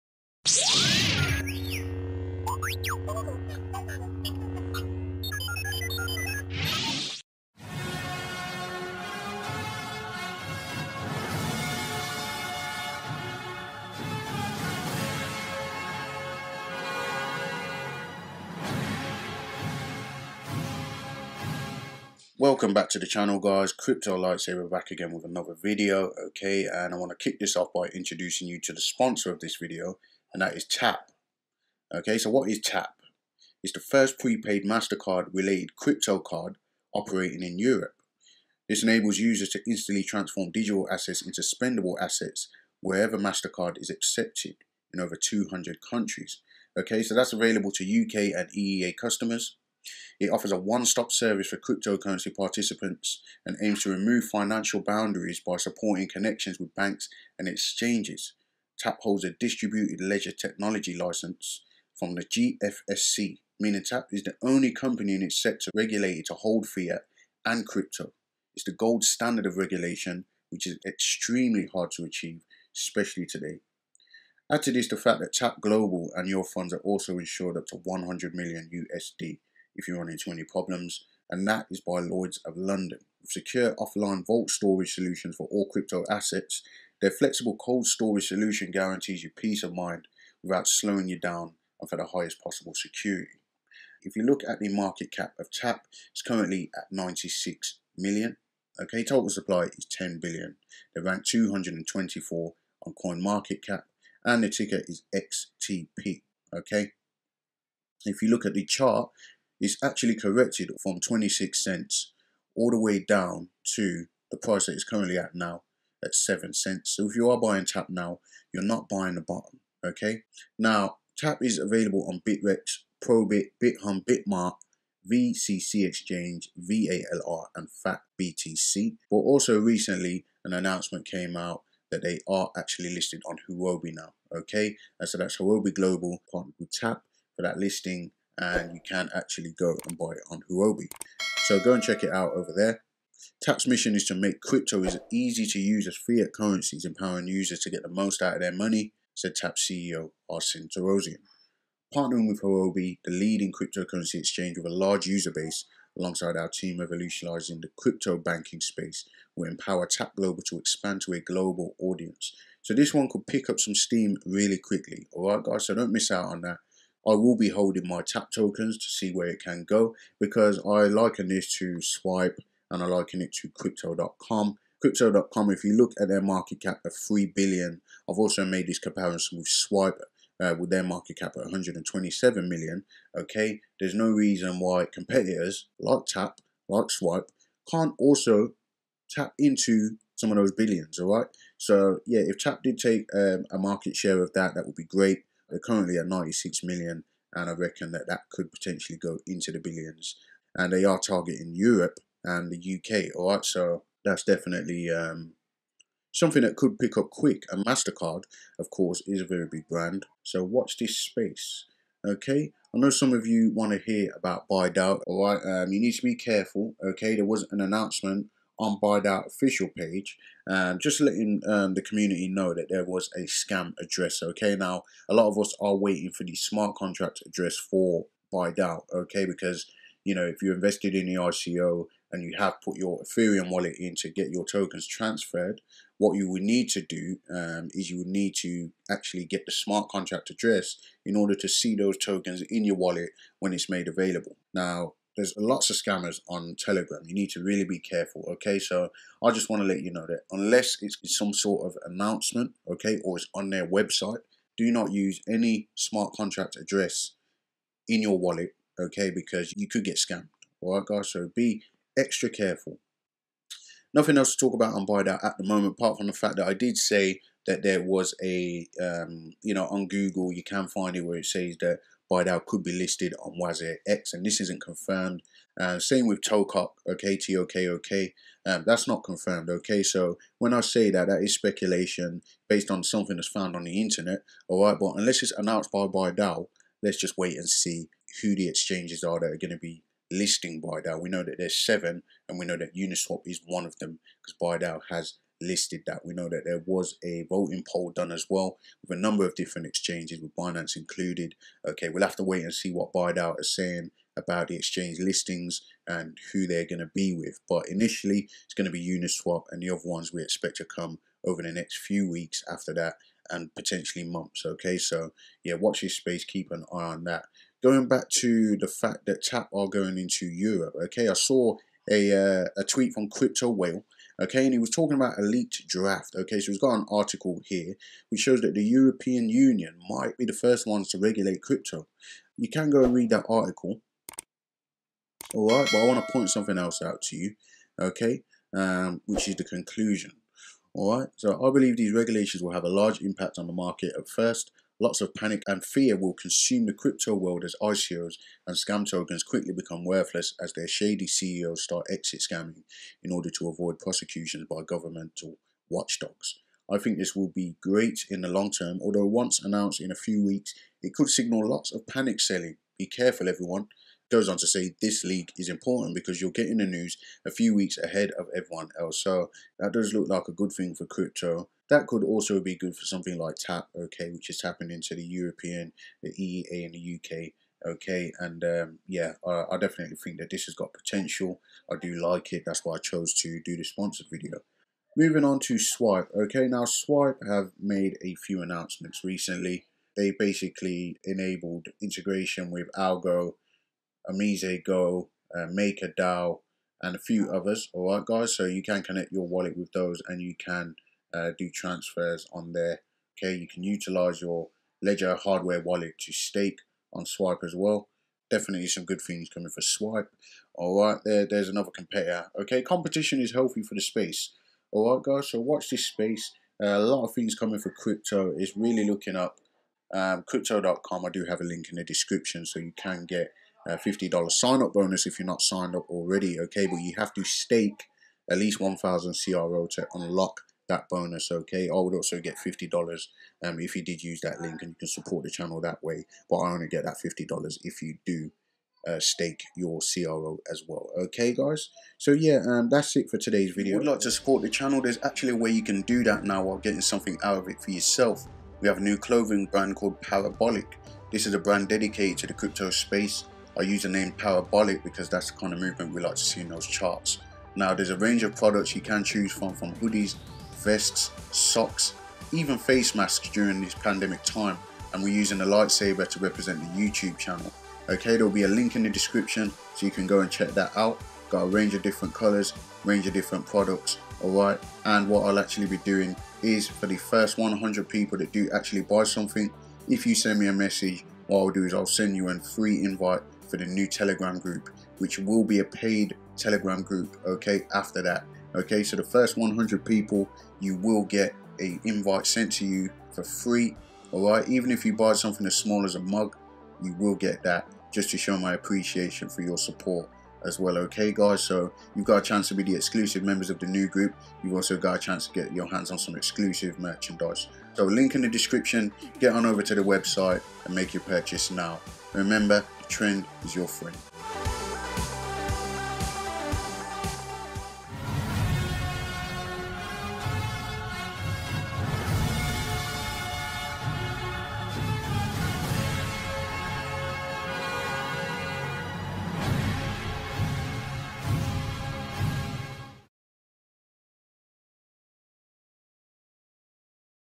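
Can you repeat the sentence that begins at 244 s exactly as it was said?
Now, there's lots of scammers on Telegram.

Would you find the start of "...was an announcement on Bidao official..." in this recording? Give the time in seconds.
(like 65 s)
217 s.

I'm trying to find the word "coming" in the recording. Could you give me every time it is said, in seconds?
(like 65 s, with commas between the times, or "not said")
409 s, 417 s.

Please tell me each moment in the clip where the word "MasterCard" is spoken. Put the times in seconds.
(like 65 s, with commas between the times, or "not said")
34 s, 43 s, 207 s.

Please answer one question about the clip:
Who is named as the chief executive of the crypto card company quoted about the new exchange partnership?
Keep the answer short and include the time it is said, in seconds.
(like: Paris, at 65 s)
Arsen Torosyan, at 150 s.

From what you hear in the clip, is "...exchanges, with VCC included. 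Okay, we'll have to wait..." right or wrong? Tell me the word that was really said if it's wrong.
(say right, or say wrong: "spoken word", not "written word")
wrong: "Binance", not "VCC".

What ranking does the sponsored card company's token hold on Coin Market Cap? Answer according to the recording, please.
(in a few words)
224.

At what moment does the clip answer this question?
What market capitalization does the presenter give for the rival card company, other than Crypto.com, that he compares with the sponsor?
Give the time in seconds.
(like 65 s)
181 s.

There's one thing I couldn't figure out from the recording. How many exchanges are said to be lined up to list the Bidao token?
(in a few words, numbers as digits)
7.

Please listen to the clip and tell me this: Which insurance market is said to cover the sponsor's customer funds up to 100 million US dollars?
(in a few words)
Lloyds of London.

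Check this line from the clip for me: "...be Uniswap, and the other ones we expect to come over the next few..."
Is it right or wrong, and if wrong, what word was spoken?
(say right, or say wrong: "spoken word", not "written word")
right.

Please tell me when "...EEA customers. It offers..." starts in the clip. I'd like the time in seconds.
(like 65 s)
48 s.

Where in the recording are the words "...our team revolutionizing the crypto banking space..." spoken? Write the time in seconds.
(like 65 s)
156 s.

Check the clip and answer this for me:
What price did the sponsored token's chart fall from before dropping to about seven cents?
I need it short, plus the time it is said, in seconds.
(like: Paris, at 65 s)
26 cents, at 110 s.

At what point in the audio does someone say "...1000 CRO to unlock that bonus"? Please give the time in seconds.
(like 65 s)
428 s.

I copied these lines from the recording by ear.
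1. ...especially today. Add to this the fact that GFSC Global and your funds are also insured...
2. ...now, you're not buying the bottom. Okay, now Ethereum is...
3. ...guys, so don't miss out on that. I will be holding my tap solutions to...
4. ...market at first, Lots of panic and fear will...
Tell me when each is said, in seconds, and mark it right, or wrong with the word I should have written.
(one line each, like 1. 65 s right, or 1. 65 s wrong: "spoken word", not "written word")
1. 72 s wrong: "TAP", not "GFSC"
2. 117 s wrong: "TAP", not "Ethereum"
3. 165 s wrong: "tokens", not "solutions"
4. 343 s right.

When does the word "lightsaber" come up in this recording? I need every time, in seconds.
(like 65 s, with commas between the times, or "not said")
24 s, 465 s.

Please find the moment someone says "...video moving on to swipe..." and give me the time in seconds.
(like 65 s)
384 s.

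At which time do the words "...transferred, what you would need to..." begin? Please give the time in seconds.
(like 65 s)
234 s.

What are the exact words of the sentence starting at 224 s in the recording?
Okay, now a lot of us are waiting for the smart contract address for Bidao.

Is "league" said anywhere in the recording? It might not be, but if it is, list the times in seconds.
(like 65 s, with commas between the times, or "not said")
365 s.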